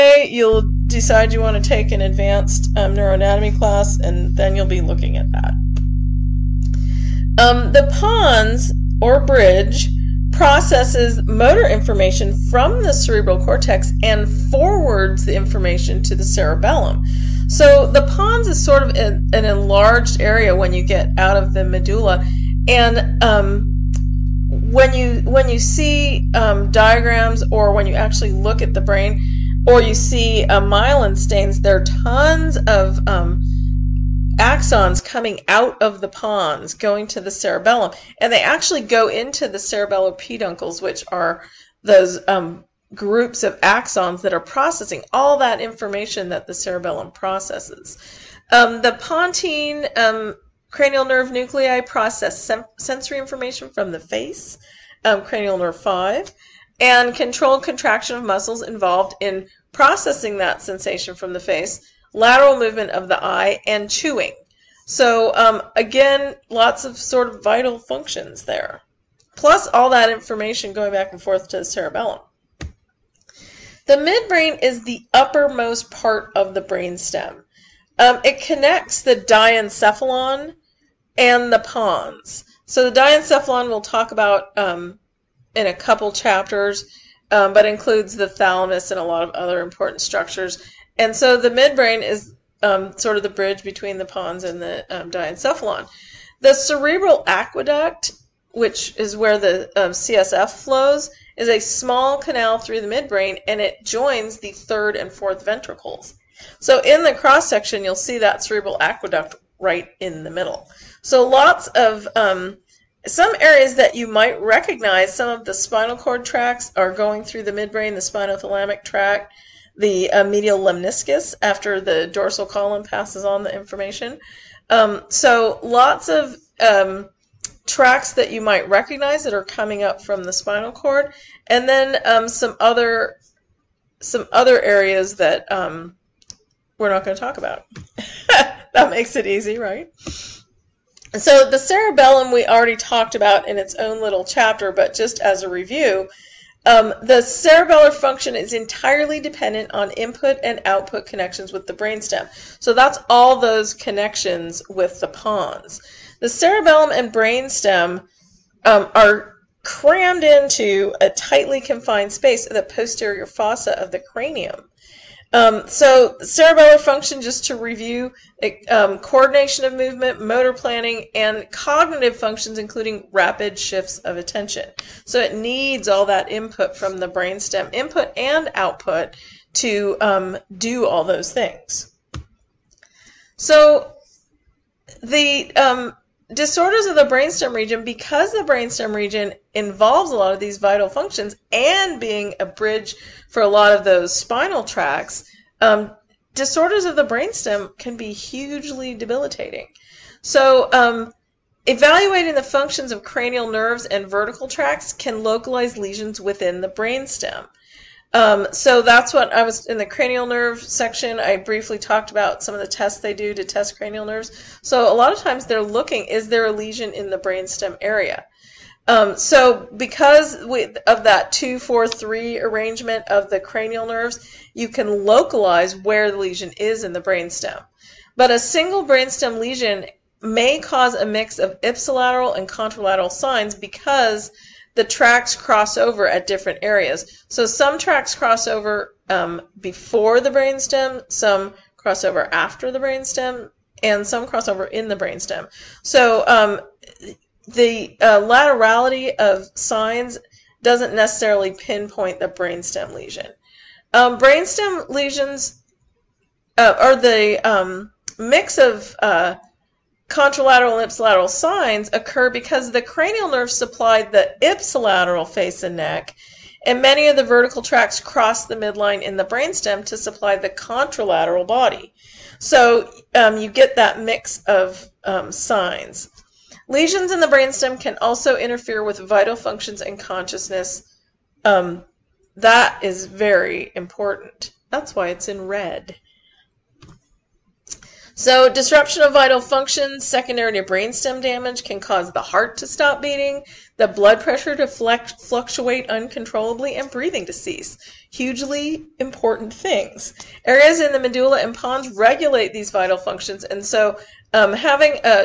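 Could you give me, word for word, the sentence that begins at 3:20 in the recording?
So, um, evaluating the functions of cranial nerves and vertical tracts can localize lesions within the brainstem.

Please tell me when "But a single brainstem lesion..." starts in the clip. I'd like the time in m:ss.
3:48.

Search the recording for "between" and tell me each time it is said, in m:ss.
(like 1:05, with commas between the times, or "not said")
1:33.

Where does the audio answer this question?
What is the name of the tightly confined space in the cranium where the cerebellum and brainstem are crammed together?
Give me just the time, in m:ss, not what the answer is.
2:42.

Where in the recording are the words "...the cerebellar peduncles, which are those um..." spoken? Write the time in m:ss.
0:39.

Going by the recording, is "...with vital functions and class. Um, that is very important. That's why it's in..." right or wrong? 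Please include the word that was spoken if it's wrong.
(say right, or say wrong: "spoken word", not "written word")
wrong: "consciousness", not "class".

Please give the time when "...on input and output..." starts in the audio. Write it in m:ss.
2:29.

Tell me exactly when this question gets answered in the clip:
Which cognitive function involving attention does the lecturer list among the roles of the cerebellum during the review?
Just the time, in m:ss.
2:53.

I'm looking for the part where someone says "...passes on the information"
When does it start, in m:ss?
2:02.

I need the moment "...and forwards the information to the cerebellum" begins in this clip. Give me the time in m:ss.
0:14.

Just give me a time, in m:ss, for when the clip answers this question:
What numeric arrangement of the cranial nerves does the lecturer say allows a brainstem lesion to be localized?
3:41.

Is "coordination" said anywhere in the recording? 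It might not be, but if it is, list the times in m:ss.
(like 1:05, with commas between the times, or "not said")
2:48.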